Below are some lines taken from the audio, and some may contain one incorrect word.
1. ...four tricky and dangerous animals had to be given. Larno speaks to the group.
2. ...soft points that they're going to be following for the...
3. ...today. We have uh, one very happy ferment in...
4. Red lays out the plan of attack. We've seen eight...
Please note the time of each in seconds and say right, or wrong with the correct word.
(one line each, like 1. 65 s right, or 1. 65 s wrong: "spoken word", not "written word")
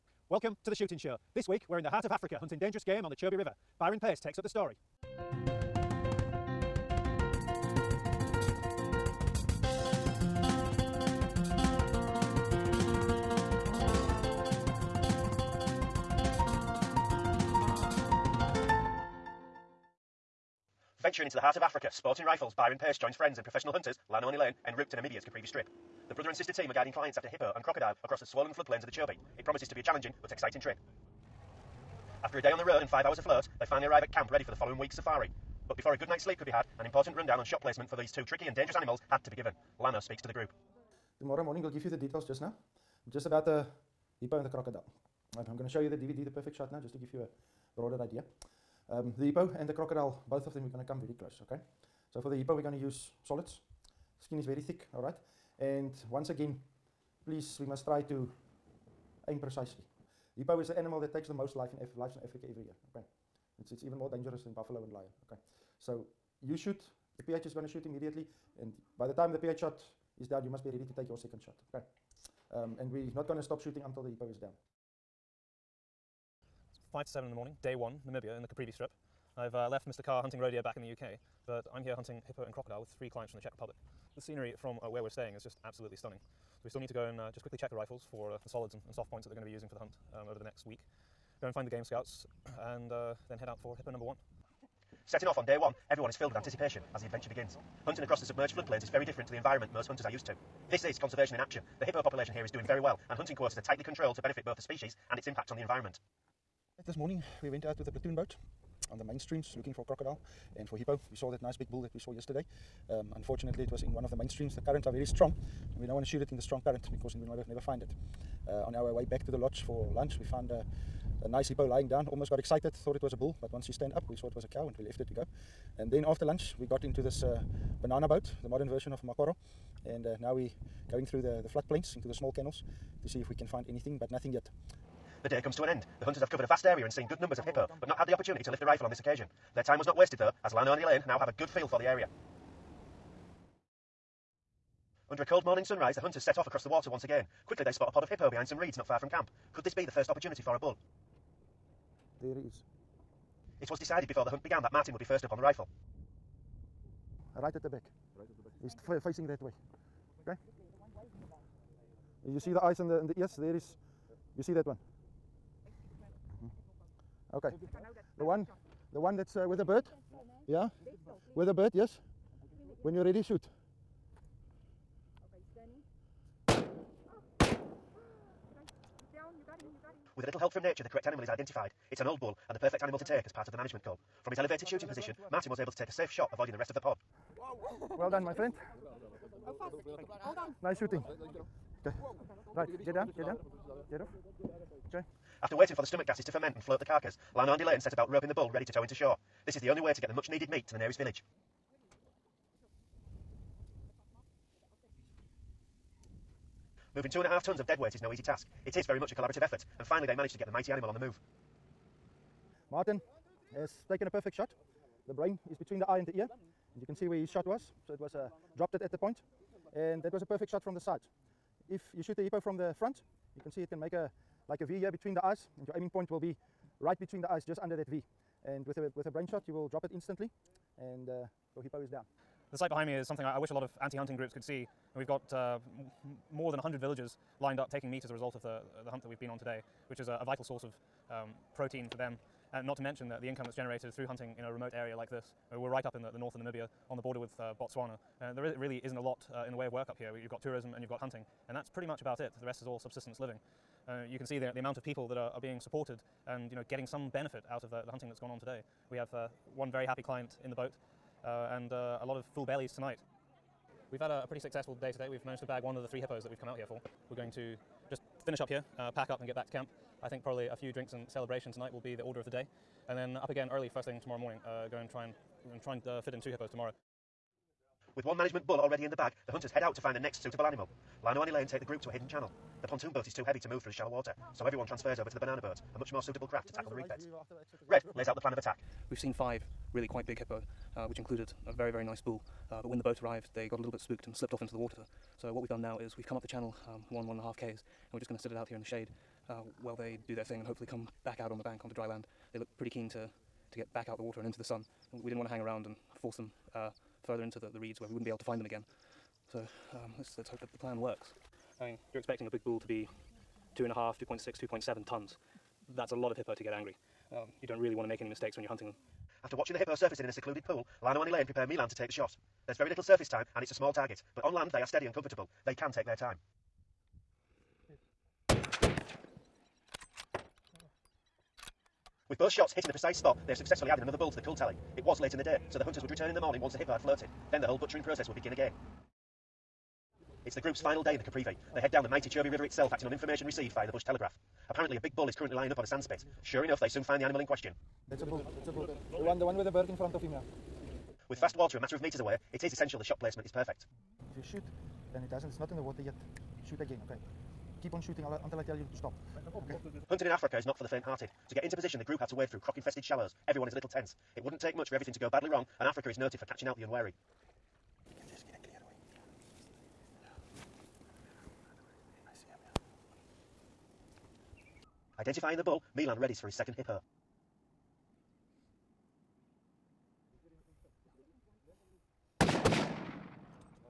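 1. 38 s wrong: "two", not "four"
2. 88 s wrong: "using", not "following"
3. 258 s wrong: "client", not "ferment"
4. 287 s wrong: "five", not "eight".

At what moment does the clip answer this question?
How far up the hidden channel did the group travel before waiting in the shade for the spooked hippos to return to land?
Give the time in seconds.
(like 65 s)
297 s.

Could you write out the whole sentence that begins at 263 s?
We've had a, a pretty successful day today.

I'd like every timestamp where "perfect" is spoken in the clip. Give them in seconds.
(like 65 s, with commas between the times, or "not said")
46 s, 182 s, 214 s, 220 s, 353 s.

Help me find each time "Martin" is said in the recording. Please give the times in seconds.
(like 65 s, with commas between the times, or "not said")
154 s, 185 s, 212 s.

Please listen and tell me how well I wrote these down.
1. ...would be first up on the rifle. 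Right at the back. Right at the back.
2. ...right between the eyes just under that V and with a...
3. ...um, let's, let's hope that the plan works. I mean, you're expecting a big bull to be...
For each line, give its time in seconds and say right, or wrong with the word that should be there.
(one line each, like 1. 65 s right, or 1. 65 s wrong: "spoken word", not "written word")
1. 154 s right
2. 226 s right
3. 309 s right.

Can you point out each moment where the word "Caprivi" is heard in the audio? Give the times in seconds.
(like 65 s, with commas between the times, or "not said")
25 s, 78 s, 341 s.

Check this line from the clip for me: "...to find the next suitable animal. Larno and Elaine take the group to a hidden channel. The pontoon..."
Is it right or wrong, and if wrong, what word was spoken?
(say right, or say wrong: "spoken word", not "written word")
right.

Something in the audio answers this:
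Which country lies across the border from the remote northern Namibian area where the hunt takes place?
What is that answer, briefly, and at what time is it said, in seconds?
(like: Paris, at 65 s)
Botswana, at 247 s.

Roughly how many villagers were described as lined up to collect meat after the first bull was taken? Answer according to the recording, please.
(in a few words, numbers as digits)
More than 100.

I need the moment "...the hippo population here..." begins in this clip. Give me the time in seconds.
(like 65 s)
101 s.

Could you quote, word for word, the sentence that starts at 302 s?
They look pretty keen to to get back out the water and into the sun.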